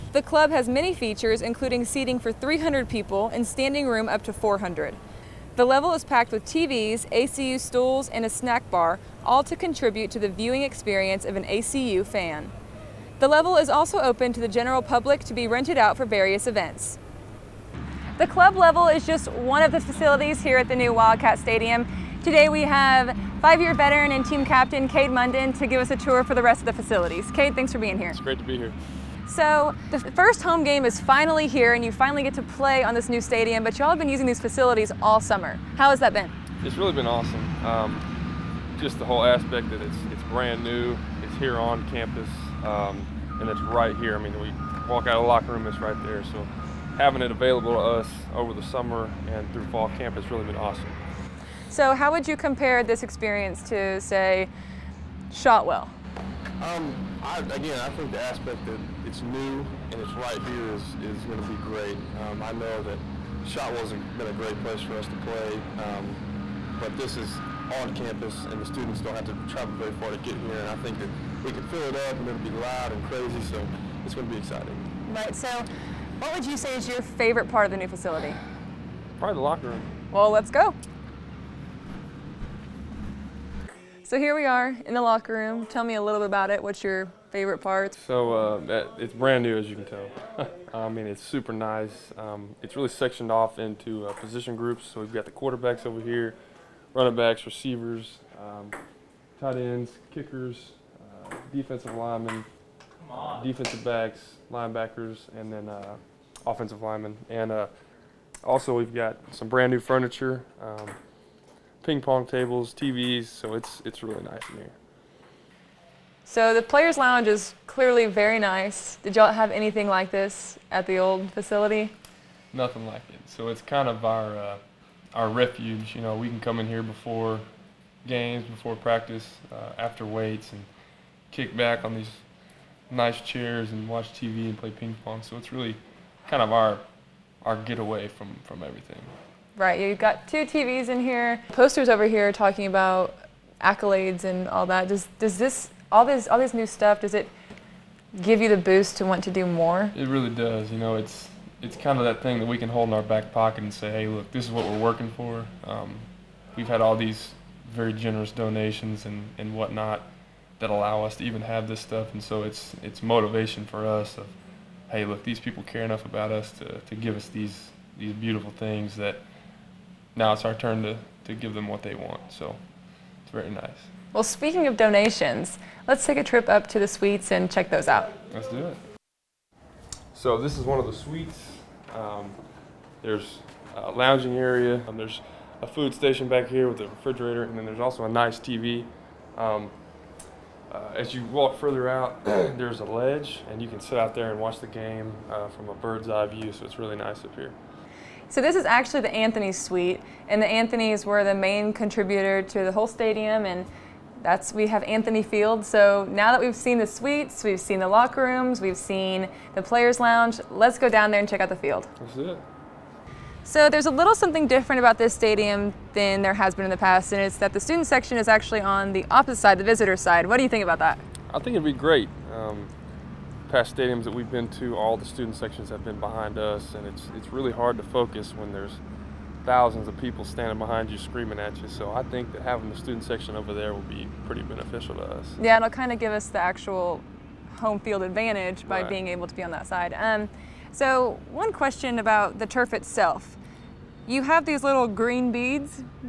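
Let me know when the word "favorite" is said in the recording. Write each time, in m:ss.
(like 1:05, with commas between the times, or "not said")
1:17, 1:27.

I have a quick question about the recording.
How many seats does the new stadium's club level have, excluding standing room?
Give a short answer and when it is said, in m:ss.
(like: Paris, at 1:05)
300, at 0:01.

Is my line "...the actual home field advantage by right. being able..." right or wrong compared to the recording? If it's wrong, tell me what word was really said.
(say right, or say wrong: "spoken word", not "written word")
right.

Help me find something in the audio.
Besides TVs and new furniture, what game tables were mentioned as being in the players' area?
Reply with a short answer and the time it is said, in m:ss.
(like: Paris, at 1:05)
Ping pong tables, at 1:51.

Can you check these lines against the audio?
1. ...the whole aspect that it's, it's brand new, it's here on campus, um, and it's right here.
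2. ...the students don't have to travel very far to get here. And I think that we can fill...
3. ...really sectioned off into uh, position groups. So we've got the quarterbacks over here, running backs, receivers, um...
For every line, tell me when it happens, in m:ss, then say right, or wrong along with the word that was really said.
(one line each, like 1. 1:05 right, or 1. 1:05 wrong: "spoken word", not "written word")
1. 0:38 right
2. 1:08 right
3. 1:32 right.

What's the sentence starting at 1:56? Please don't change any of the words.
So the players' lounge is clearly very nice.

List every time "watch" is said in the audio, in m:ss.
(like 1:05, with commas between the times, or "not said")
2:13, 3:14.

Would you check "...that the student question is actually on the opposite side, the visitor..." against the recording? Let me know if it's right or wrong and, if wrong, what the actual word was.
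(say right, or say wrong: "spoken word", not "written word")
wrong: "section", not "question".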